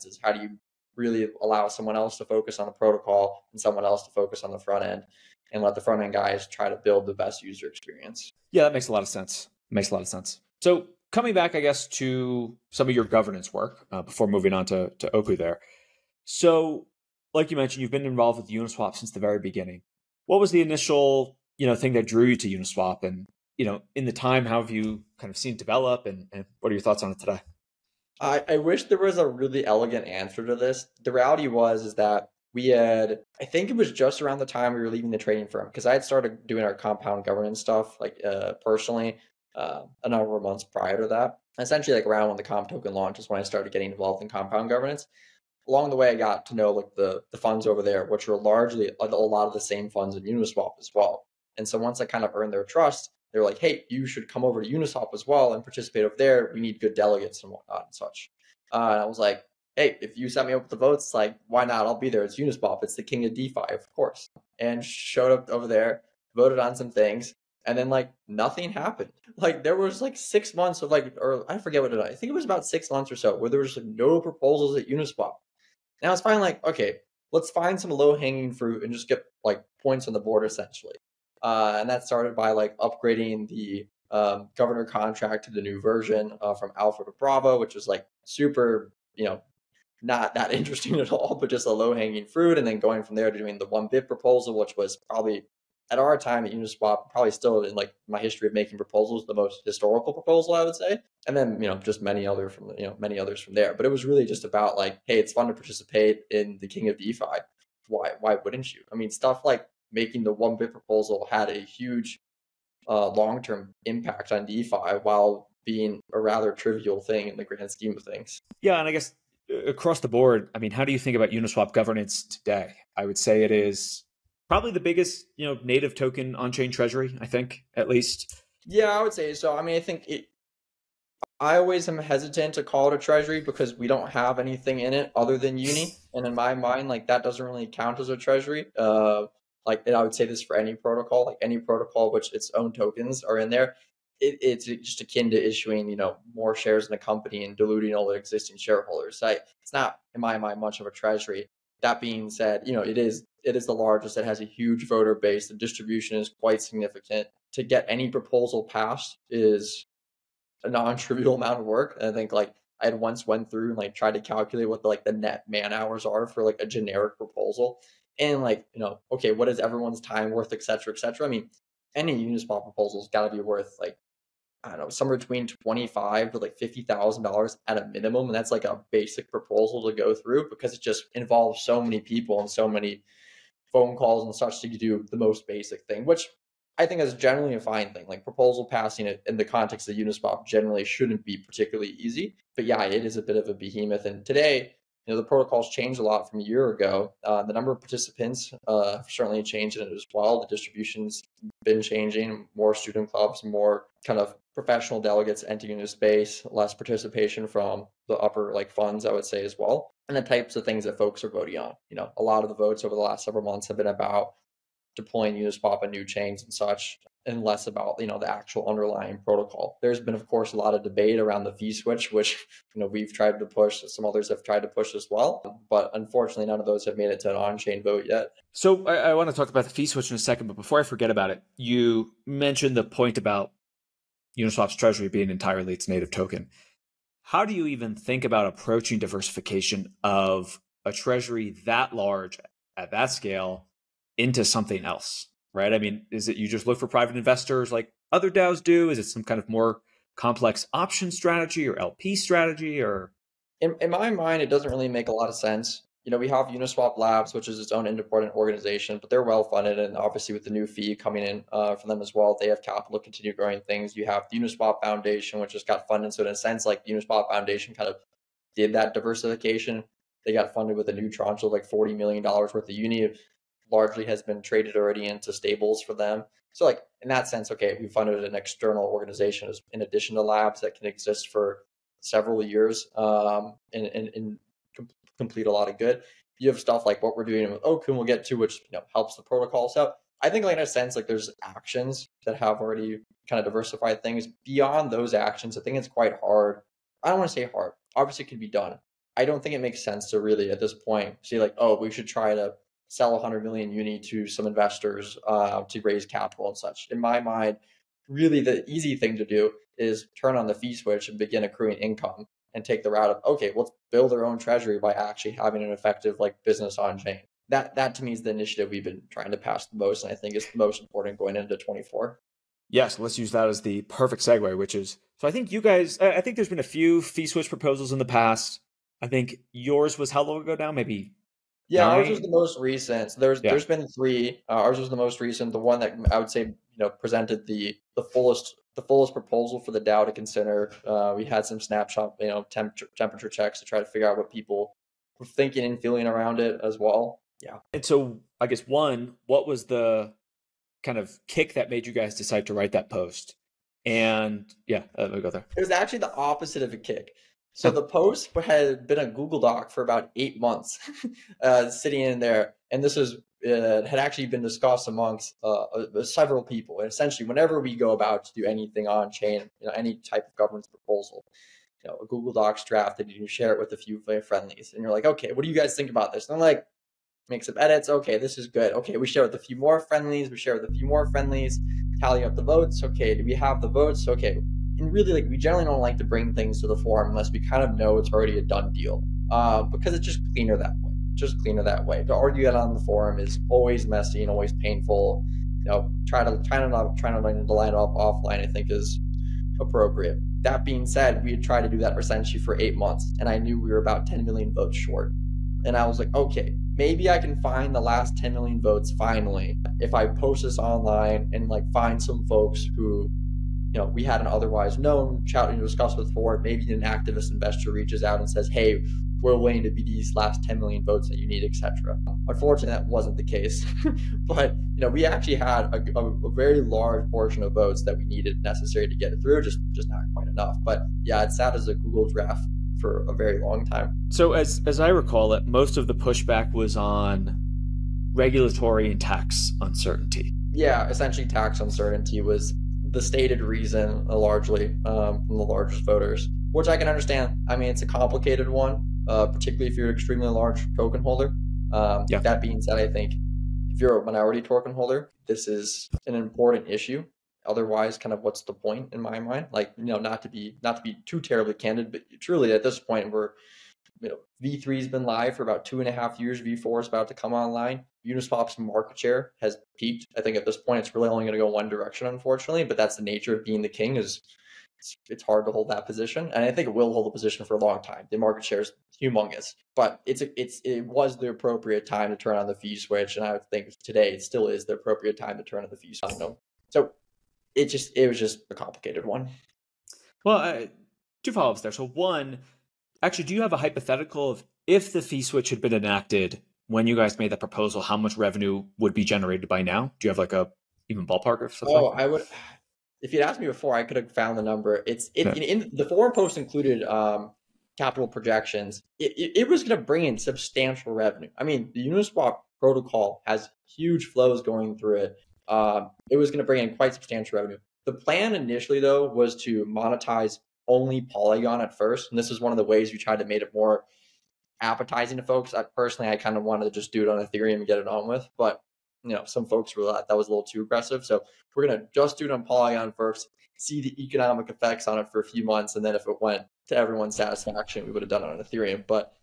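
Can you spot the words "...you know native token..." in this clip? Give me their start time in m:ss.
2:05.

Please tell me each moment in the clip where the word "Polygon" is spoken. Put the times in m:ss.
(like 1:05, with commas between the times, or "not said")
8:41, 8:52.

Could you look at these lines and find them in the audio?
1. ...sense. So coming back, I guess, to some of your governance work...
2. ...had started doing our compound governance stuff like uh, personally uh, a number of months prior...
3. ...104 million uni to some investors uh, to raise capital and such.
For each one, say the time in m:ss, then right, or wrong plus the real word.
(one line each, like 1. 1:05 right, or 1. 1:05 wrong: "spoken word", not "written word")
1. 0:10 right
2. 0:35 right
3. 5:03 wrong: "100", not "104".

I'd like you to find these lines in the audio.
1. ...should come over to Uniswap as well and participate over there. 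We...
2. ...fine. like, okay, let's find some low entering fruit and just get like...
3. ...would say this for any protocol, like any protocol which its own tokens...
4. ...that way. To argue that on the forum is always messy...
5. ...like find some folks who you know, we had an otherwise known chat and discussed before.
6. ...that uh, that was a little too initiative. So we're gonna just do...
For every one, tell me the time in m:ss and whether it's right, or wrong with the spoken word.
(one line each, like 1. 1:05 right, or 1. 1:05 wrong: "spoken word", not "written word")
1. 0:54 right
2. 1:16 wrong: "hanging", not "entering"
3. 2:20 right
4. 6:31 right
5. 6:51 right
6. 8:49 wrong: "aggressive", not "initiative".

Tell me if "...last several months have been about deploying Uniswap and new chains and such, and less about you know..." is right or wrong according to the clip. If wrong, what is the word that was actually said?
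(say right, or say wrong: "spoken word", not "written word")
right.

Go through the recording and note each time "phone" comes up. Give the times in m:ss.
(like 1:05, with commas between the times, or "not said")
3:03.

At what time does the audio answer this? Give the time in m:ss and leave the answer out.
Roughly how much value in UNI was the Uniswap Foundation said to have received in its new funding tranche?
4:31.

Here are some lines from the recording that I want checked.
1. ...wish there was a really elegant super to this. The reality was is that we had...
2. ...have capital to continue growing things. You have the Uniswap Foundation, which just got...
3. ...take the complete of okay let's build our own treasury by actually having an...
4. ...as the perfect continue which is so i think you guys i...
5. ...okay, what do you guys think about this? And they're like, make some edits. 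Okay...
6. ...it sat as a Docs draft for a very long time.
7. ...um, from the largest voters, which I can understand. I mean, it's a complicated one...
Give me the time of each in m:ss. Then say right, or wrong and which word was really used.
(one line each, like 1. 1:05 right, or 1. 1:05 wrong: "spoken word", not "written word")
1. 0:28 wrong: "answer", not "super"
2. 4:22 right
3. 5:12 wrong: "route", not "complete"
4. 5:23 wrong: "segue", not "continue"
5. 6:15 right
6. 7:11 wrong: "Google", not "Docs"
7. 7:24 right.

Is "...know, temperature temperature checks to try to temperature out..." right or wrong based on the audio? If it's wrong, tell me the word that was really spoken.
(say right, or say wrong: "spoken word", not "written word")
wrong: "figure", not "temperature".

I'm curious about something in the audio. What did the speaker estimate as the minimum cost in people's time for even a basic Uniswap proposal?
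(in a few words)
$25,000 to $50,000.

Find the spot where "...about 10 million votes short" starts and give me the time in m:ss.
6:43.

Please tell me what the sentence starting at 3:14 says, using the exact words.
And today, you know, the protocols changed a lot from a year ago.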